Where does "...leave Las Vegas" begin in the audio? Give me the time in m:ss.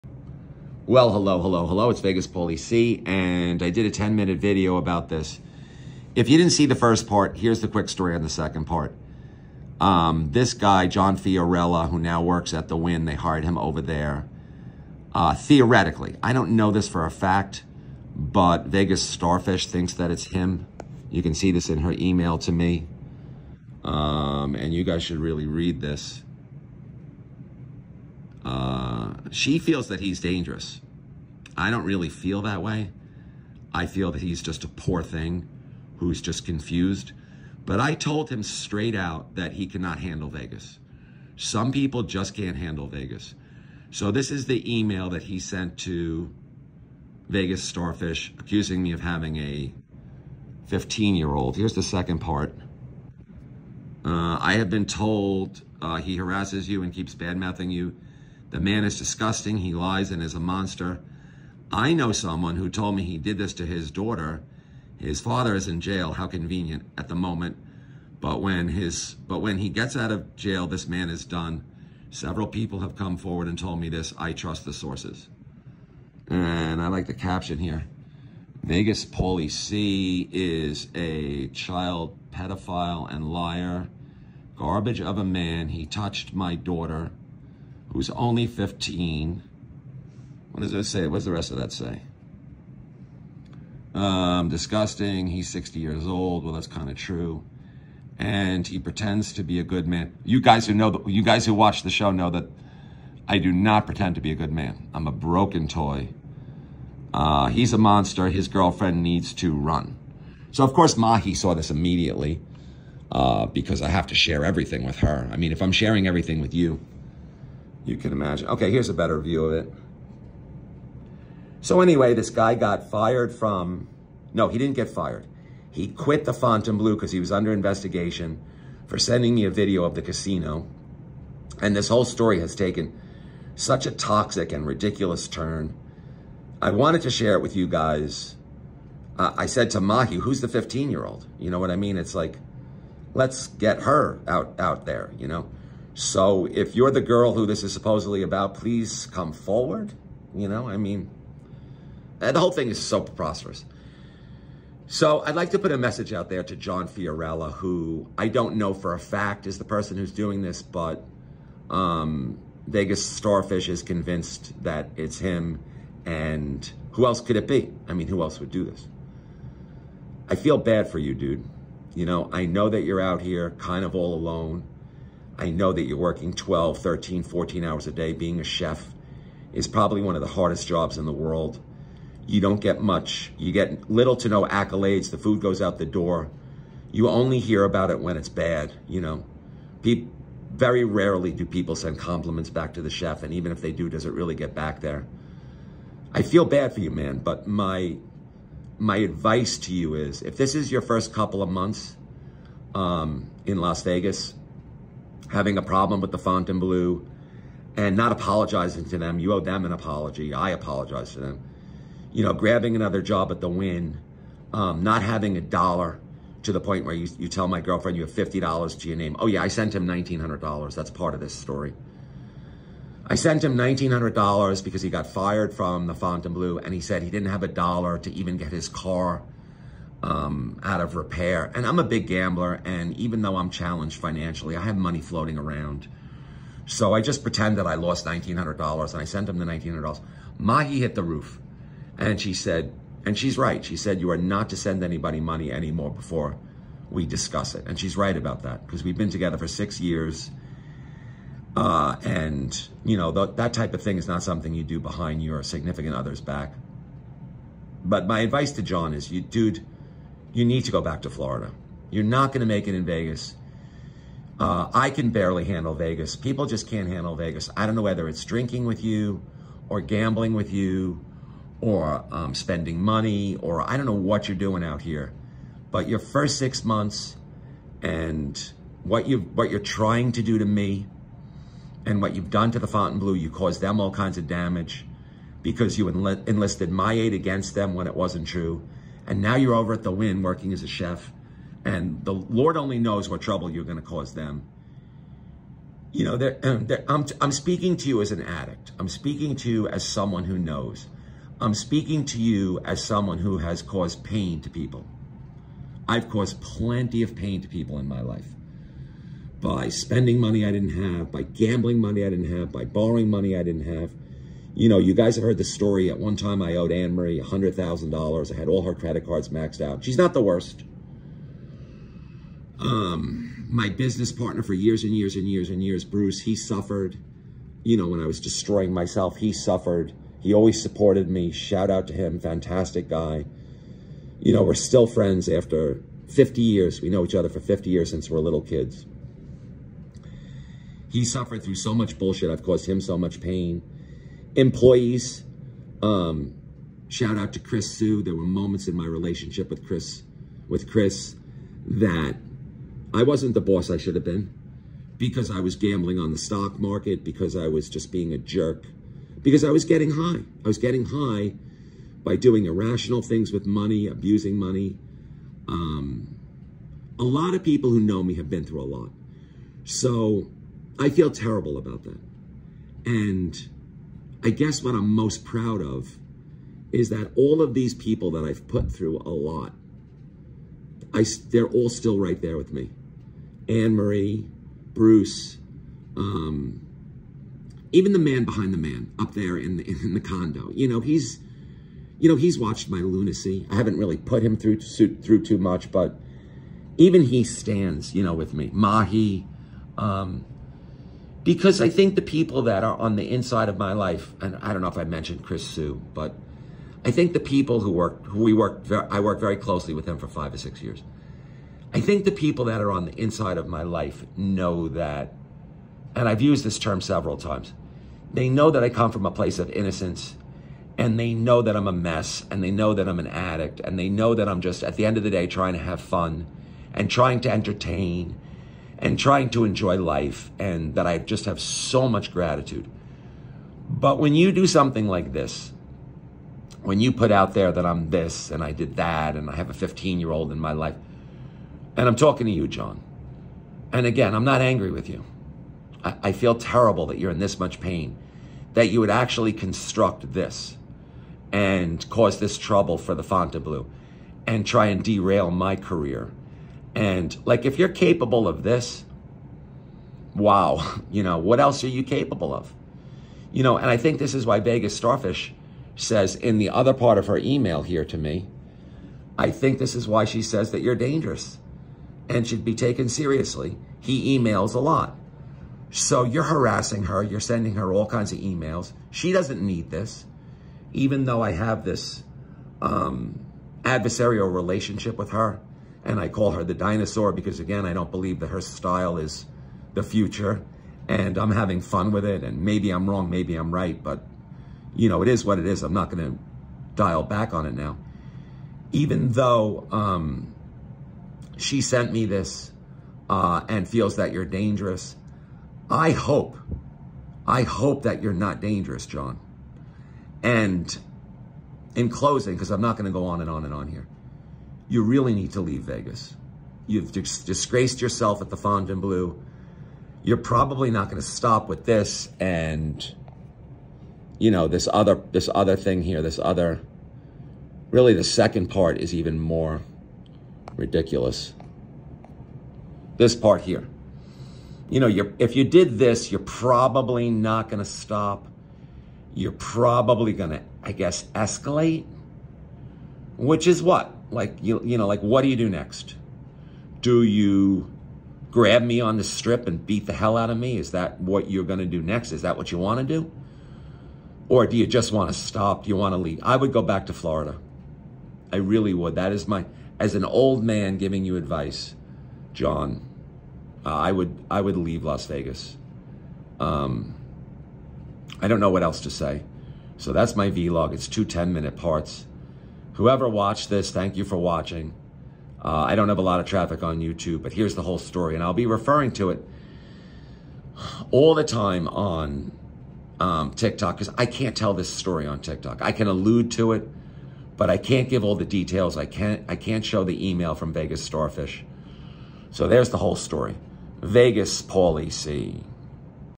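9:24.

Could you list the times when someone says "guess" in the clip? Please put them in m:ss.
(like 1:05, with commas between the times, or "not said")
6:14, 9:00.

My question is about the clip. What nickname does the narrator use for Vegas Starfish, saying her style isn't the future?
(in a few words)
the dinosaur.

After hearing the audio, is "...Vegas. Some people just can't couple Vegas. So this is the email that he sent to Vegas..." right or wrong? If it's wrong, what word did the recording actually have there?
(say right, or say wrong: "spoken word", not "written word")
wrong: "handle", not "couple".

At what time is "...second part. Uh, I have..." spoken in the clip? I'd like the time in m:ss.
0:51.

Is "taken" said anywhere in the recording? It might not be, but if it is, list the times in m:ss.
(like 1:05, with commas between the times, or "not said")
2:12, 7:52.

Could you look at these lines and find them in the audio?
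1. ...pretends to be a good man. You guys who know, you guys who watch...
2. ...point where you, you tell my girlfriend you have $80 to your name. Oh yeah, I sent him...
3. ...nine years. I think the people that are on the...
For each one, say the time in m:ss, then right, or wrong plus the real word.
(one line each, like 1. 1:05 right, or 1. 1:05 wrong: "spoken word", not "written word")
1. 1:38 right
2. 3:36 wrong: "50", not "80"
3. 6:50 wrong: "six", not "nine".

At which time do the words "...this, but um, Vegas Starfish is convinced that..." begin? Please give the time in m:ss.
2:40.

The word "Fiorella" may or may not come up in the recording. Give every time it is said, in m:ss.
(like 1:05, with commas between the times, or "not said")
0:11, 2:36.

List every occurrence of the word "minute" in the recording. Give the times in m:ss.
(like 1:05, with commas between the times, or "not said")
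0:04, 9:31.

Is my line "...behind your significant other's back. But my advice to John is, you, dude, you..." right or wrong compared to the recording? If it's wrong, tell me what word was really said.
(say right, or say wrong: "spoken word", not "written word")
right.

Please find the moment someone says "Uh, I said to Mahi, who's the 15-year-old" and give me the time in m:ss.
2:19.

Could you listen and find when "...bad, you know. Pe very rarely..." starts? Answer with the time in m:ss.
3:08.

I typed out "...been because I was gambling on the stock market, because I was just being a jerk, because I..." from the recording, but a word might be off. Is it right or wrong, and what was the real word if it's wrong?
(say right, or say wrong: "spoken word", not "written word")
right.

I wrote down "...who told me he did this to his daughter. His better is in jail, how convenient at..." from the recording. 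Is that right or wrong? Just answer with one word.
wrong.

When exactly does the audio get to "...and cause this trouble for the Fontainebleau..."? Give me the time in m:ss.
7:31.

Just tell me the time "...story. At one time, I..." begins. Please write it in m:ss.
5:15.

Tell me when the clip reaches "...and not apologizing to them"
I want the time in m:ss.
3:27.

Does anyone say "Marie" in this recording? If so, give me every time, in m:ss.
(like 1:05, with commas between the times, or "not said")
5:16, 6:23.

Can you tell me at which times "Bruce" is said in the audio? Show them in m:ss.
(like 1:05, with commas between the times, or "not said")
5:25, 6:24.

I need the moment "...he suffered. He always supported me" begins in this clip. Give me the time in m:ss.
5:29.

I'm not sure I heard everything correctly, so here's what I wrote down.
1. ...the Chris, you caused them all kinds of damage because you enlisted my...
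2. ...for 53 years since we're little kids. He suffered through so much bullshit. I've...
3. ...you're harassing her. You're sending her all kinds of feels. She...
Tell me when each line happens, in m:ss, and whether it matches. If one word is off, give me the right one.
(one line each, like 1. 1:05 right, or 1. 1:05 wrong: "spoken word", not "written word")
1. 4:42 wrong: "Fontainebleau", not "Chris"
2. 5:37 wrong: "50", not "53"
3. 7:56 wrong: "emails", not "feels".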